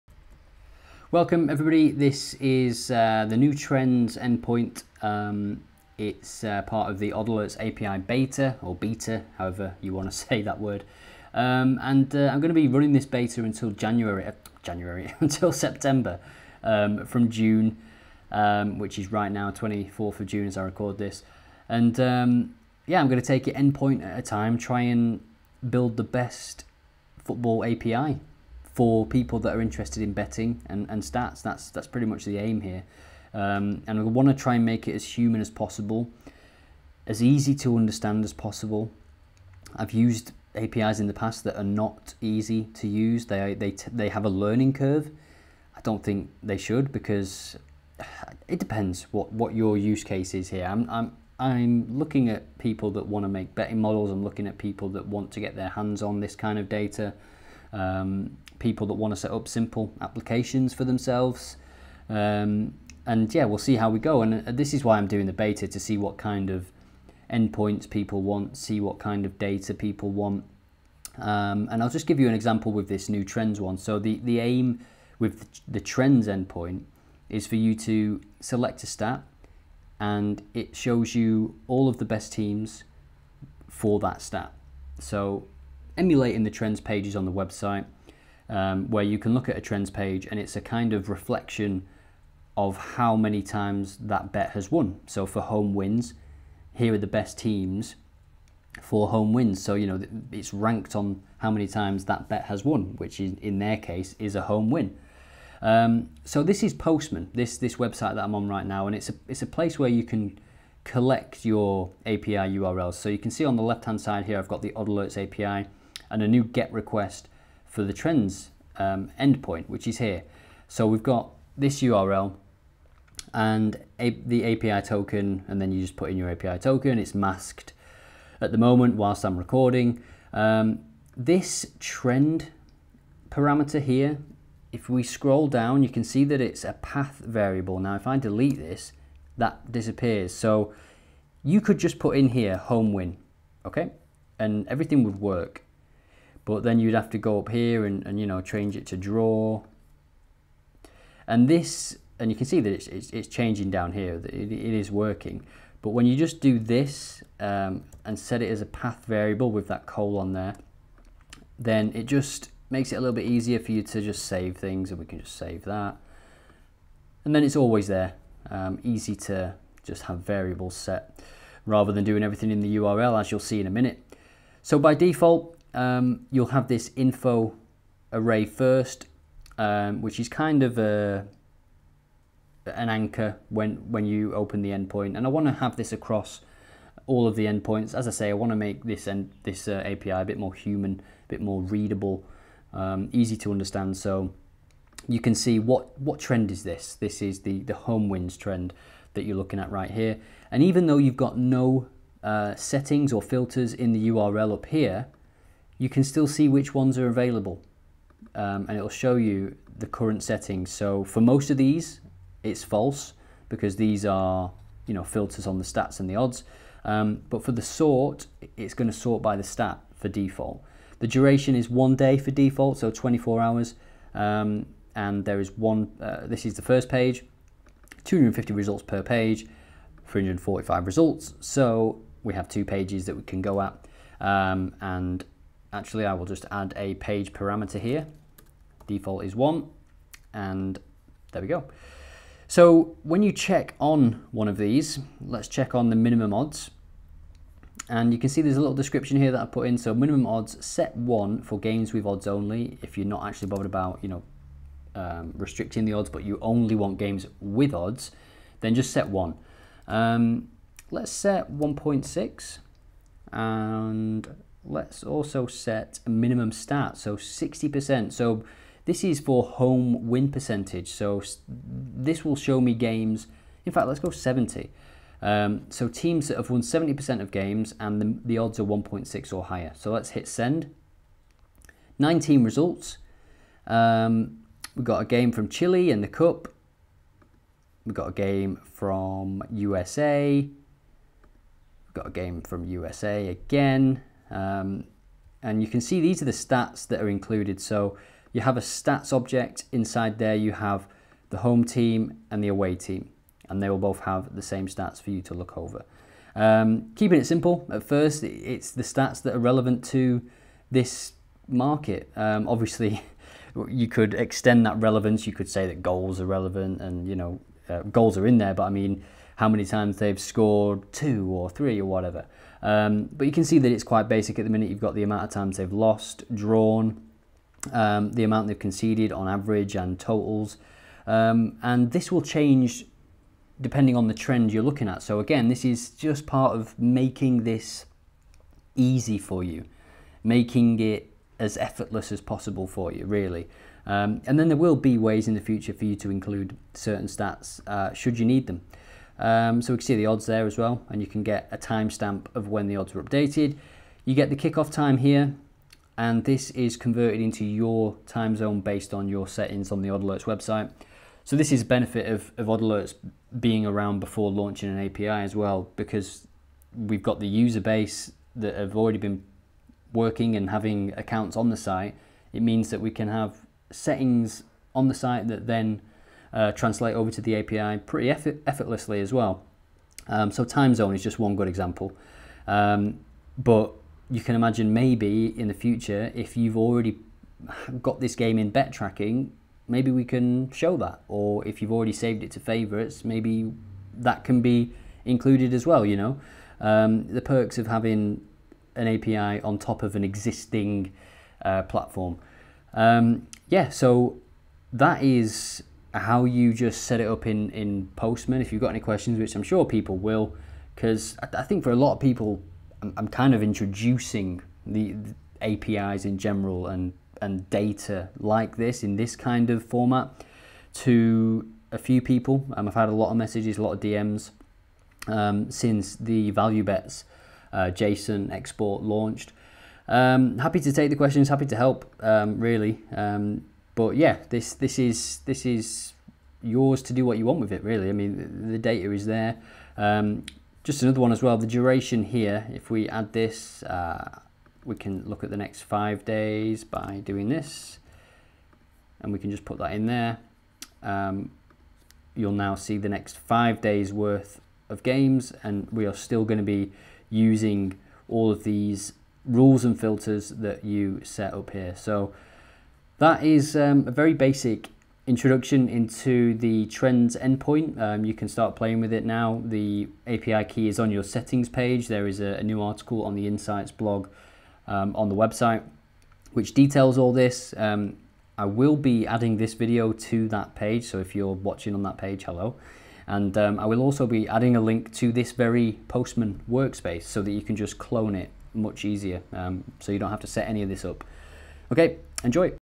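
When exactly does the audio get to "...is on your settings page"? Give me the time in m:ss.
7:50.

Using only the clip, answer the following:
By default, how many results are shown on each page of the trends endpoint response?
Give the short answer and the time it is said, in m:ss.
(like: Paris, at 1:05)
250, at 3:48.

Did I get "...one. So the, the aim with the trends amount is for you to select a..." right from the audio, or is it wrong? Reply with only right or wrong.
wrong.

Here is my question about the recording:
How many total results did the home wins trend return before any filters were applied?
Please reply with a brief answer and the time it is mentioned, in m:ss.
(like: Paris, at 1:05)
345, at 3:50.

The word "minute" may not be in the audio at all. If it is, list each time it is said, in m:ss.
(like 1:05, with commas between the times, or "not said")
2:53, 5:24.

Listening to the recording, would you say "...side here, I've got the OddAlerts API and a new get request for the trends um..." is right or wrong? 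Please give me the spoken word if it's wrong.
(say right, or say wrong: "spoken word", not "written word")
right.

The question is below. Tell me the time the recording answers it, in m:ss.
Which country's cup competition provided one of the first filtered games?
4:45.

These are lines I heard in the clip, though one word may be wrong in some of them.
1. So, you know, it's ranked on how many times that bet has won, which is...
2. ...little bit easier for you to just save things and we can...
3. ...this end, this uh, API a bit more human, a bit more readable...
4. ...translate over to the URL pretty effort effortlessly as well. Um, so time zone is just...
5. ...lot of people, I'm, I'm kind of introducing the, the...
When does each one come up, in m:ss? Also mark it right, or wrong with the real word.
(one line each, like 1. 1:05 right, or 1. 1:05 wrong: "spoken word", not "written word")
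1. 1:39 right
2. 2:42 right
3. 3:08 right
4. 6:16 wrong: "API", not "URL"
5. 6:51 right.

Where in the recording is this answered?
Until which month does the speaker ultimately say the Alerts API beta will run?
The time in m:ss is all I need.
0:15.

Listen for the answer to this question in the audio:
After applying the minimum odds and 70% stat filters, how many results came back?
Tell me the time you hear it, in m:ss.
4:41.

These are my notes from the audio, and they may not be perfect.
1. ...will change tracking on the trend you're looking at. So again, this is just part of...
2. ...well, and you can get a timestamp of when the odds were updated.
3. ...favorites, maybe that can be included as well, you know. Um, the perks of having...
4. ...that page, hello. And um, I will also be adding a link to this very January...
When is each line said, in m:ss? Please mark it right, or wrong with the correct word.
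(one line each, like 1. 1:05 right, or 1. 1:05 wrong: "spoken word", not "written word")
1. 5:32 wrong: "depending", not "tracking"
2. 5:50 right
3. 6:32 right
4. 8:01 wrong: "Postman", not "January".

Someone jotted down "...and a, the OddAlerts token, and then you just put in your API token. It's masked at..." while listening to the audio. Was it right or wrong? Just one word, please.
wrong.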